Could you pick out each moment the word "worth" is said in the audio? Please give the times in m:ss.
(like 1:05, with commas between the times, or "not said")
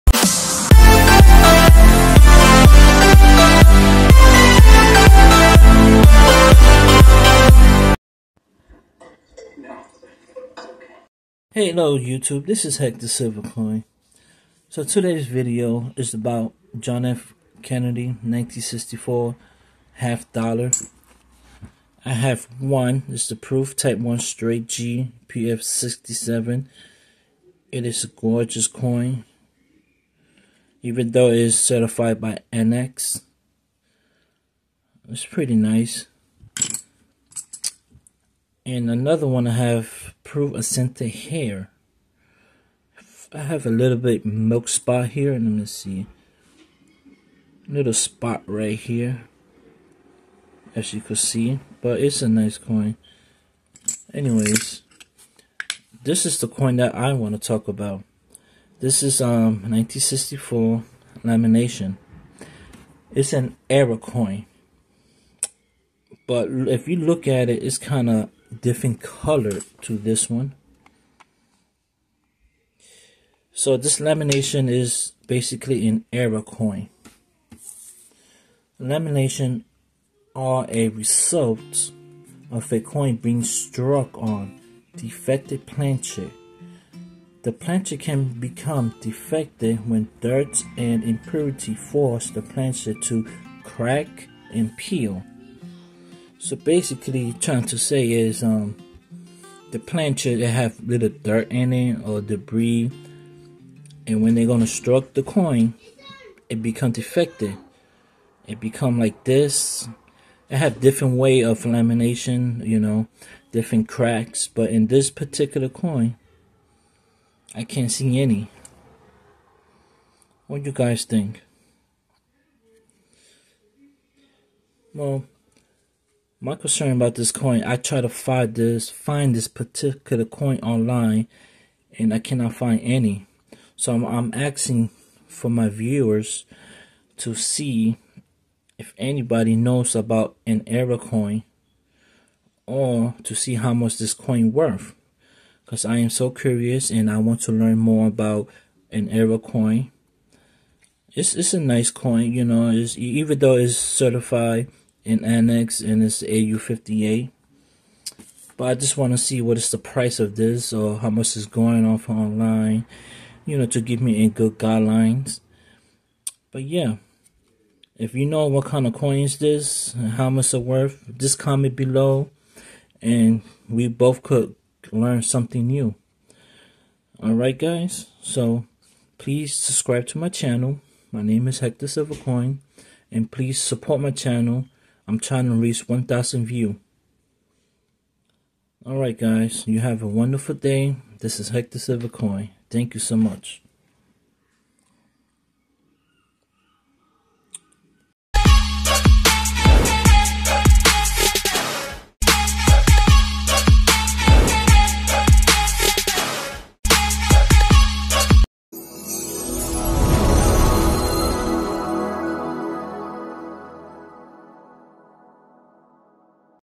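2:24, 2:50.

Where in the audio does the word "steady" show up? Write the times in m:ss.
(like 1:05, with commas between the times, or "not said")
not said.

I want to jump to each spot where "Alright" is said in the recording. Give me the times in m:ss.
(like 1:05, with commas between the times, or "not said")
2:57, 3:08.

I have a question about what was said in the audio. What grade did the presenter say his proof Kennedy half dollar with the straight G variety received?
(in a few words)
PF67.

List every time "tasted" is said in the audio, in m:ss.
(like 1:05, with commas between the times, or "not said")
not said.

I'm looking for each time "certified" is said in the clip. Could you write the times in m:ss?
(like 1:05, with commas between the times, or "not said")
0:31, 2:33.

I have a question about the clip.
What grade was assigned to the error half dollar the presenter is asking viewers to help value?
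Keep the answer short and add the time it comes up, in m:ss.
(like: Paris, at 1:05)
AU58, at 2:36.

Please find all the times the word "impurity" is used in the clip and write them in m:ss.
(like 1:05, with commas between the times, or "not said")
1:31.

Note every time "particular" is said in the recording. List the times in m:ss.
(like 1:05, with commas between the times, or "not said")
1:55, 2:09.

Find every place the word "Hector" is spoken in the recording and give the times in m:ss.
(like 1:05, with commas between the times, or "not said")
0:12, 3:01, 3:11.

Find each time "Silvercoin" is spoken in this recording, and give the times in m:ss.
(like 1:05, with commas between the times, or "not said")
0:13, 3:01, 3:11.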